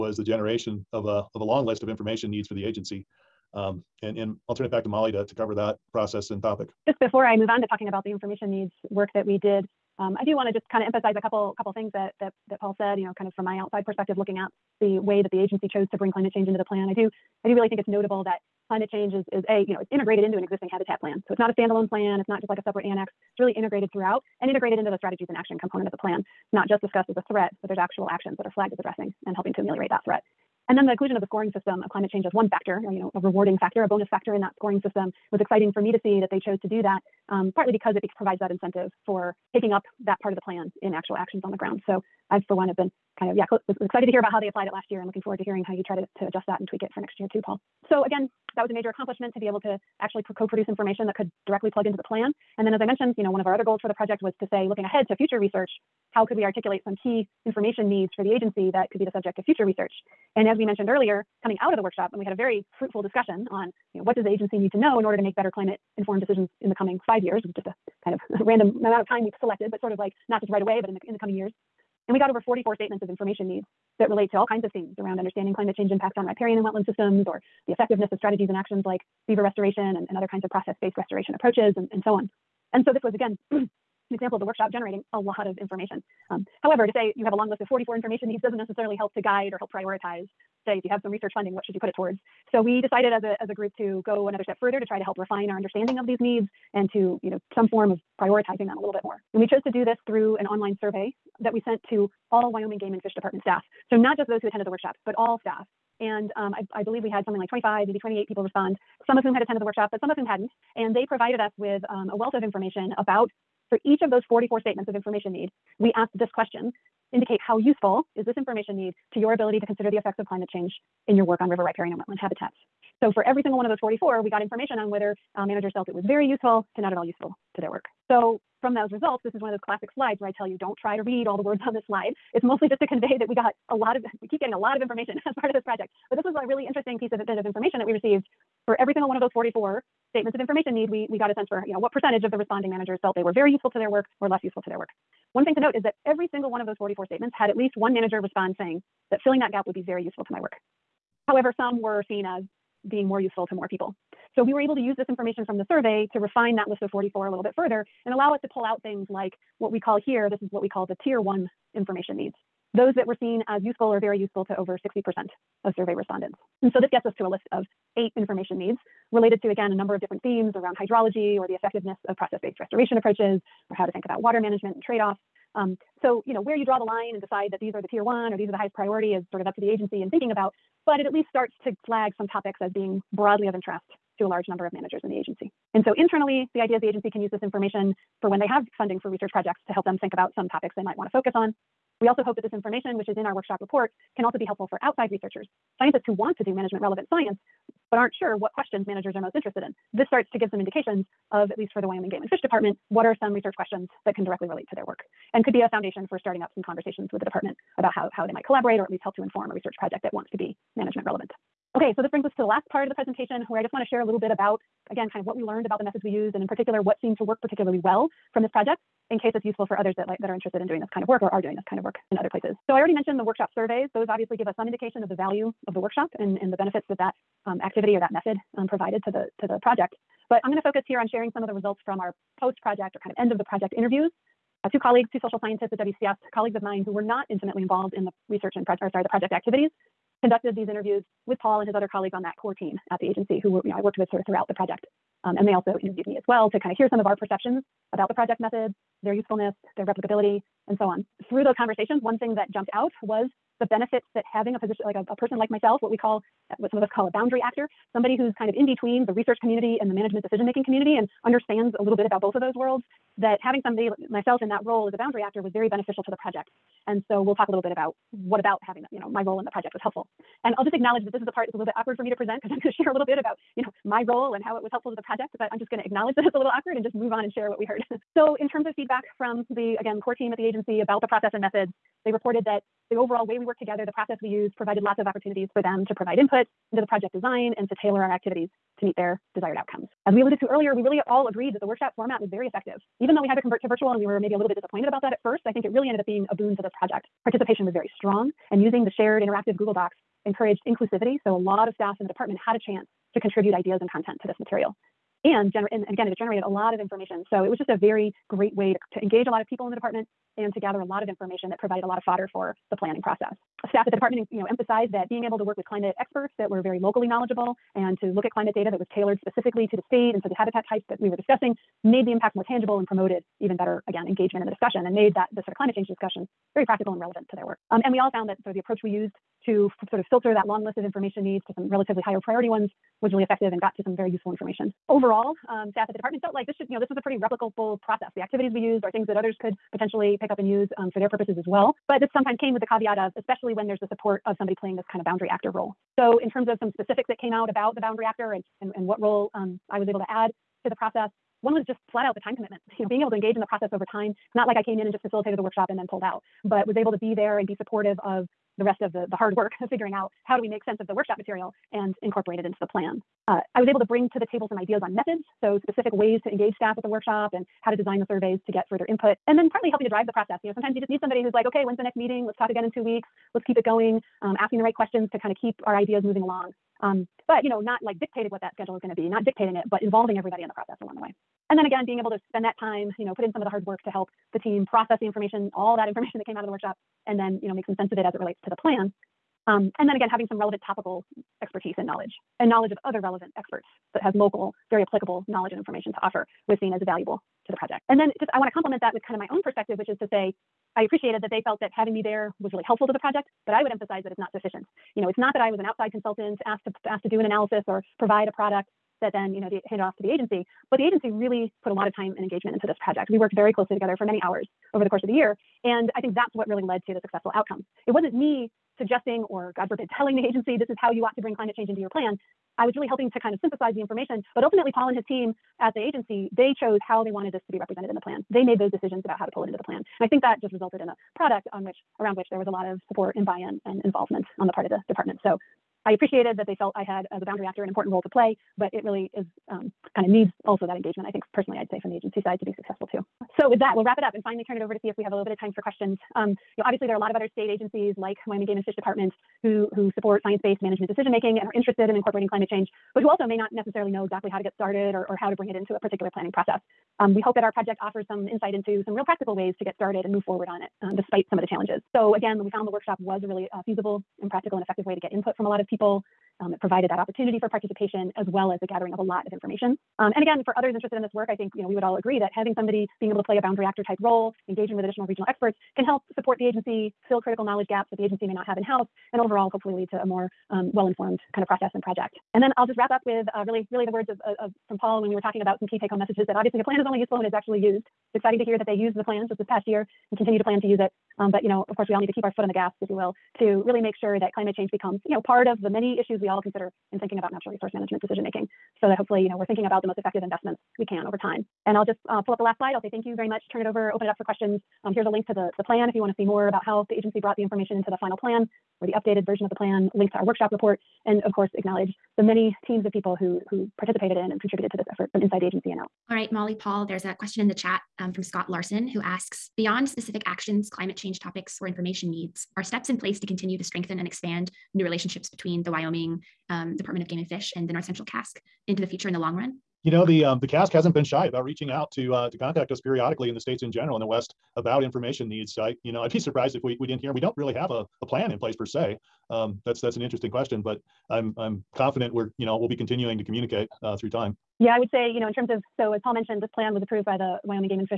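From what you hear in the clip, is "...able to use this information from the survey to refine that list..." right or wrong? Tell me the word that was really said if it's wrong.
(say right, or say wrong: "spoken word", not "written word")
right.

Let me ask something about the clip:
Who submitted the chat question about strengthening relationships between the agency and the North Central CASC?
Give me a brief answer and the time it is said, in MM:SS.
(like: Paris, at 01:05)
Scott Larson, at 08:38.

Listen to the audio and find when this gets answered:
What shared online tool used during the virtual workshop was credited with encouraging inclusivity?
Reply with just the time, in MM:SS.
04:59.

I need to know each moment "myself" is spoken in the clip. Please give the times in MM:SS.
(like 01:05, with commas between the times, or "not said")
04:15, 04:24.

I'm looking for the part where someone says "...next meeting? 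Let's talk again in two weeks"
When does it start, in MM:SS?
06:11.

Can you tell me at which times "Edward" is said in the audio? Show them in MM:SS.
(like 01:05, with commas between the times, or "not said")
not said.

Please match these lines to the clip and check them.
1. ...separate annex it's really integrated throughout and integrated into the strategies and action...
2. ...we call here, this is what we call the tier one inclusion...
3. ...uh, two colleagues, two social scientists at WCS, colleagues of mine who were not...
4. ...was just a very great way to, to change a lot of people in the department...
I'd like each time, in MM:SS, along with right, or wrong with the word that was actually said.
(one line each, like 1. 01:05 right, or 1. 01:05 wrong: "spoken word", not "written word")
1. 00:22 right
2. 02:39 wrong: "information", not "inclusion"
3. 03:54 right
4. 05:07 wrong: "engage", not "change".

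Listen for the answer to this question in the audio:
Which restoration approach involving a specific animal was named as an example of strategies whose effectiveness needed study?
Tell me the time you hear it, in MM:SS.
01:19.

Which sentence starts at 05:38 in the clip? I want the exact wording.
The activities we used are things that others could potentially pick up and use um, for their purposes as well.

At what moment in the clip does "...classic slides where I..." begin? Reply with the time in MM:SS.
02:09.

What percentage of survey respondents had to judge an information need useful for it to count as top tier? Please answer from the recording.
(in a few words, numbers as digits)
60%.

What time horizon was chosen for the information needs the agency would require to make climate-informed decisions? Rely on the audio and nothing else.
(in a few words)
5 years.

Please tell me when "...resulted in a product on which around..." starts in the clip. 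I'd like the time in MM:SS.
07:10.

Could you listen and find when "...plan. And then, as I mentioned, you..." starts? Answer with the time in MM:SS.
00:52.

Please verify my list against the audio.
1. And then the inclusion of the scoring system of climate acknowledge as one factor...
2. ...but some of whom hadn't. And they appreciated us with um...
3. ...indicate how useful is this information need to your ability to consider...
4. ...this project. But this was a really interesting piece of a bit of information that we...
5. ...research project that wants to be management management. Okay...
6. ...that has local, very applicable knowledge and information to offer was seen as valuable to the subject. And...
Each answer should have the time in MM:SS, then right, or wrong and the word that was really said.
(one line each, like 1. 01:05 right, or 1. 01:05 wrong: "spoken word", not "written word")
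1. 00:30 wrong: "change", not "acknowledge"
2. 01:49 wrong: "provided", not "appreciated"
3. 01:57 right
4. 02:15 right
5. 03:29 wrong: "relevant", not "management"
6. 06:33 wrong: "project", not "subject".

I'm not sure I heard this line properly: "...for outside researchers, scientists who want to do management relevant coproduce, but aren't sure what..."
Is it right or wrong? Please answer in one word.
wrong.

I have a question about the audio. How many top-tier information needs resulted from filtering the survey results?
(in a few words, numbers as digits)
8.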